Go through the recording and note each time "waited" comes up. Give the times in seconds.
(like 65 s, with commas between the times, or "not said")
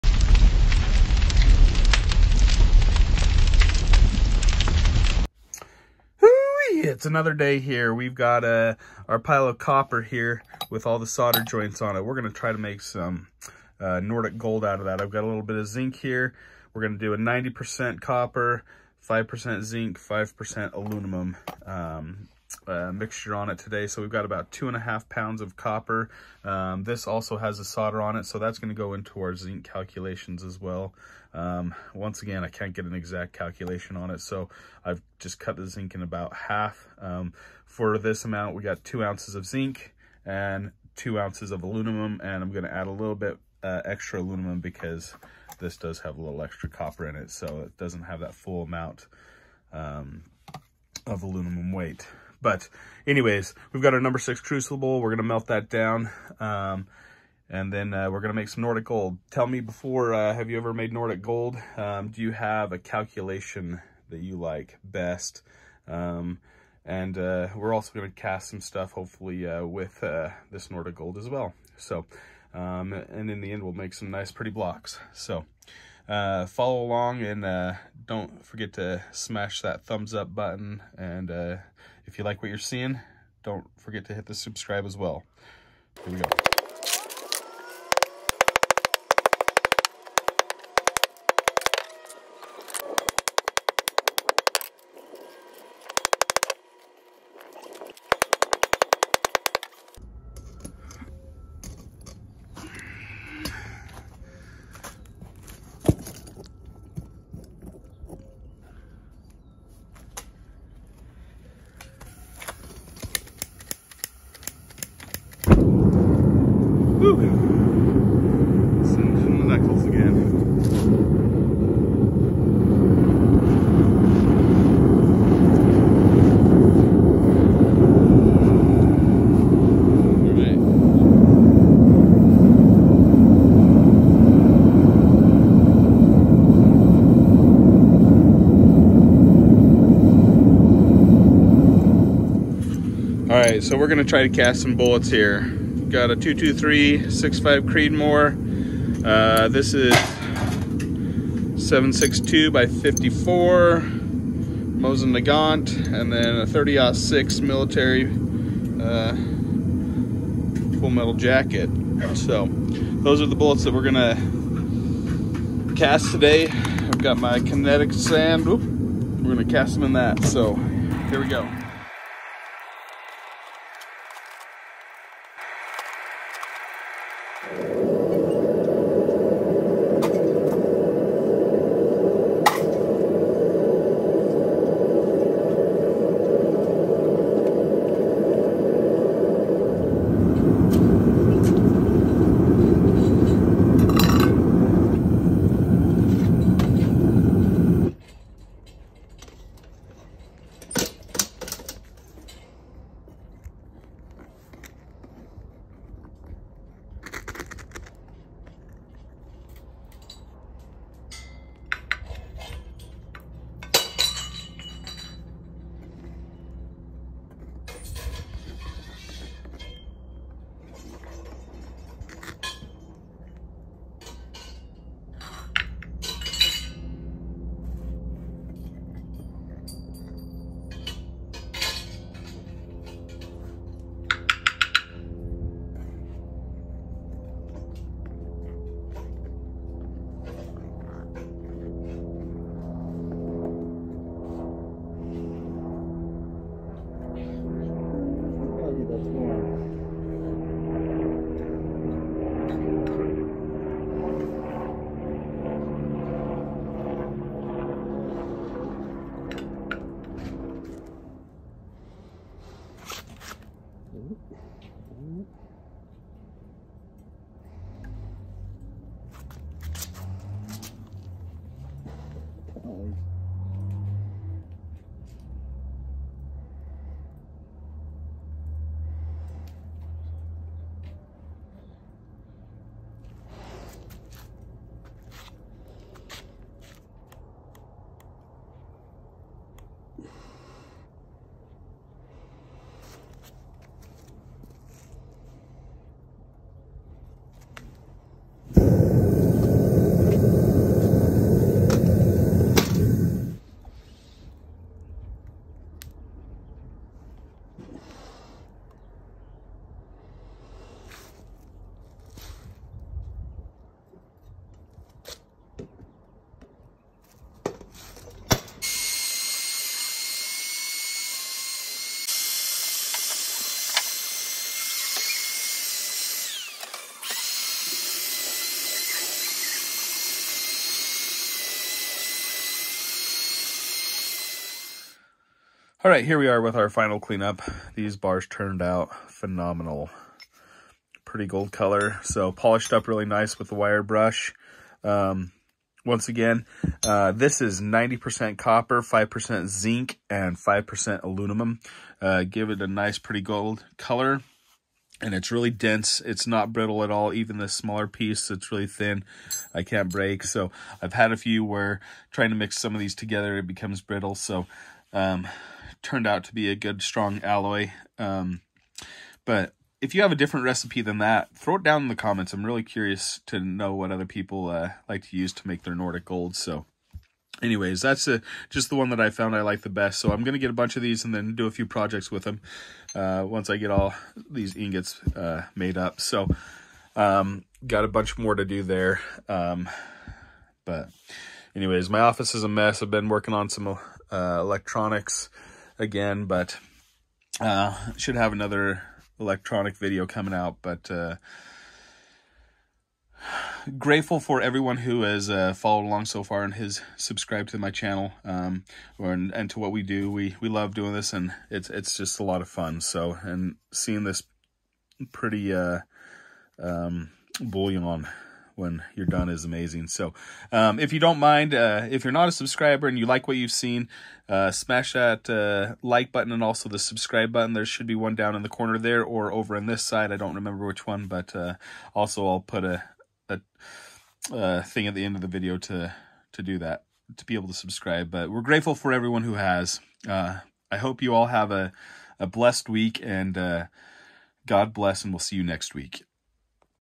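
not said.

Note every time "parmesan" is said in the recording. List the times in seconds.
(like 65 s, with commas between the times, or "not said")
not said.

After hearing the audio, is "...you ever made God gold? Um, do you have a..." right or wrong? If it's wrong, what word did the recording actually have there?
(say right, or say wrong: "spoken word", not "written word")
wrong: "Nordic", not "God".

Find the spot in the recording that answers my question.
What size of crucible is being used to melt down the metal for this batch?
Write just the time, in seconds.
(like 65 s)
54 s.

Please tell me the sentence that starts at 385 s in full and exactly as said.
So um, got a bunch more to do there.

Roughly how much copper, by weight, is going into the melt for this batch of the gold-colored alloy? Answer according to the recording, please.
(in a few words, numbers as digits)
2.5 pounds.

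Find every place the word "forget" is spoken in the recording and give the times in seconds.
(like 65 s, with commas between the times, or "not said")
78 s, 83 s.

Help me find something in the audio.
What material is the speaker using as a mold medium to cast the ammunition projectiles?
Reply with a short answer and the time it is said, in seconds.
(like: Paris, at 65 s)
kinetic sand, at 167 s.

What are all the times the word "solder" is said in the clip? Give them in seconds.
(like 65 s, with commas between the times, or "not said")
11 s, 27 s.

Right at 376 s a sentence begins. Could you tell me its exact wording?
So anyways, that's a, uh, just the one that I found I like the best.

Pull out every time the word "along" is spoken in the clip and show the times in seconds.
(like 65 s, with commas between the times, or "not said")
76 s, 405 s.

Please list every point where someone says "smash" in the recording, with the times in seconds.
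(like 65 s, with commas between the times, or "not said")
79 s, 424 s.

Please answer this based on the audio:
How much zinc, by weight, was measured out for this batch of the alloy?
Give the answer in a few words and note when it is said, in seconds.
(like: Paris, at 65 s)
2 ounces, at 38 s.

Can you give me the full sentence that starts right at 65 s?
Um, and uh, we're also going to cast some stuff, hopefully, uh, with uh, this Nordic gold as well.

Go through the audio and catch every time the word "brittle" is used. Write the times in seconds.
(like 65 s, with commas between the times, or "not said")
356 s, 363 s.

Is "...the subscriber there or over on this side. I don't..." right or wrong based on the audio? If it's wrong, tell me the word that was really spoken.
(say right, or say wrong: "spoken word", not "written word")
wrong: "corner", not "subscriber".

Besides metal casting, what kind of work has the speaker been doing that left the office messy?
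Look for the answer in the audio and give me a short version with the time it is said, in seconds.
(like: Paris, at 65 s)
electronics, at 394 s.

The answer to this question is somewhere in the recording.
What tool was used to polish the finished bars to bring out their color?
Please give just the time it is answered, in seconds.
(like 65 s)
343 s.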